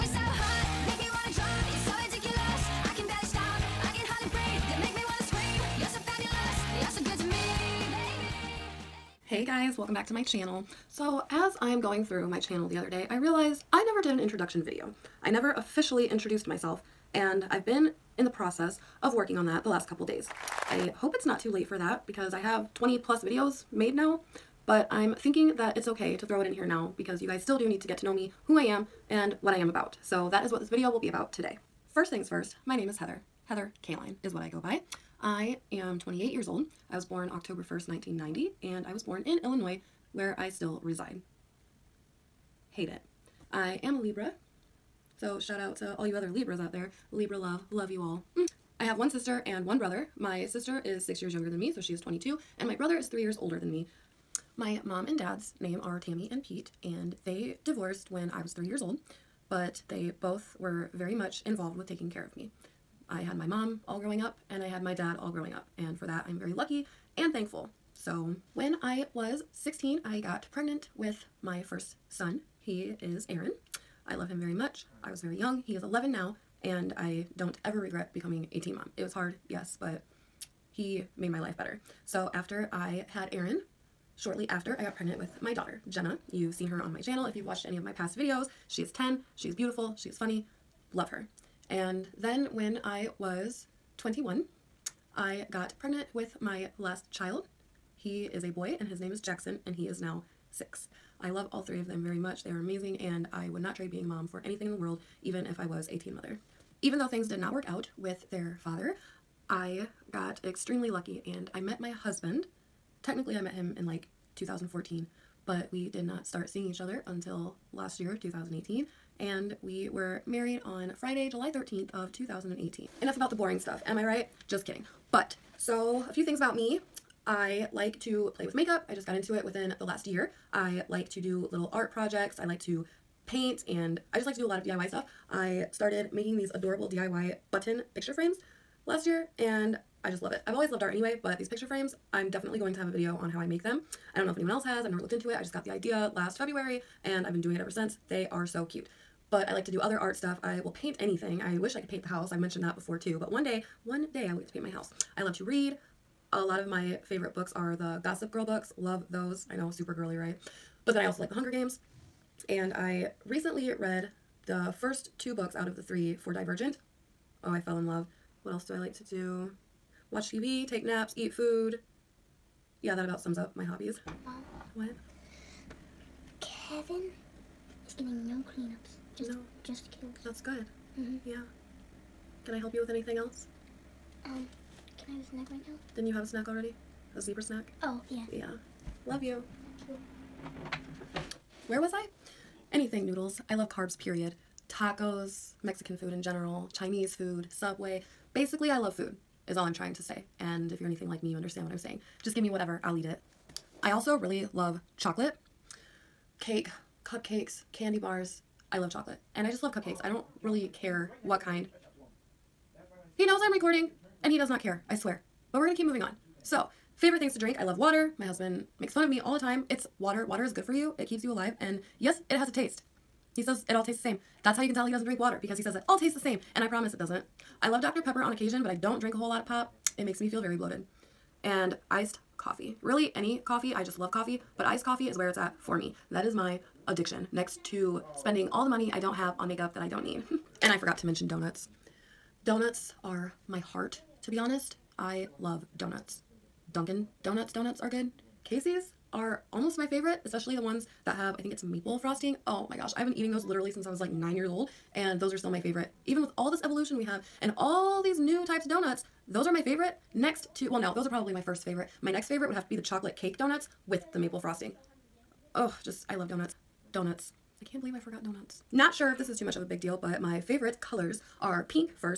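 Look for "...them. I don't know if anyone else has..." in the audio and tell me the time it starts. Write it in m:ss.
2:23.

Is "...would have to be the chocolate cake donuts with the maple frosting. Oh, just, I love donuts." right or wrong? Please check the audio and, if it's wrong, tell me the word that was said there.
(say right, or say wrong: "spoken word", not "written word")
right.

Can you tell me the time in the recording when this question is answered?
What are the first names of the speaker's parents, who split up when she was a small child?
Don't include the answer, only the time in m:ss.
0:55.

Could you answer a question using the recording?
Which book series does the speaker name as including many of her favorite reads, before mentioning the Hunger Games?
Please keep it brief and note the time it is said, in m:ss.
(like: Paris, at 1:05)
Gossip Girl, at 2:38.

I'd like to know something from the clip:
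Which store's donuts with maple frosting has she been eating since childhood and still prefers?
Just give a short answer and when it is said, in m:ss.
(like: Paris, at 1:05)
Casey's, at 4:08.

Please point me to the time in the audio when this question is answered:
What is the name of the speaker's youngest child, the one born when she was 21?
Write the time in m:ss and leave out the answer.
1:39.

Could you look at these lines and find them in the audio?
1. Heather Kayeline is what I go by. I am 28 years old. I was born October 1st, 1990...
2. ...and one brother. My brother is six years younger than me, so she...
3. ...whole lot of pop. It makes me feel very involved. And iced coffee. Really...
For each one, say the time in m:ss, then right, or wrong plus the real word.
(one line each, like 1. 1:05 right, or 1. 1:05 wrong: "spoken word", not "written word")
1. 0:33 right
2. 0:49 wrong: "sister", not "brother"
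3. 3:49 wrong: "bloated", not "involved".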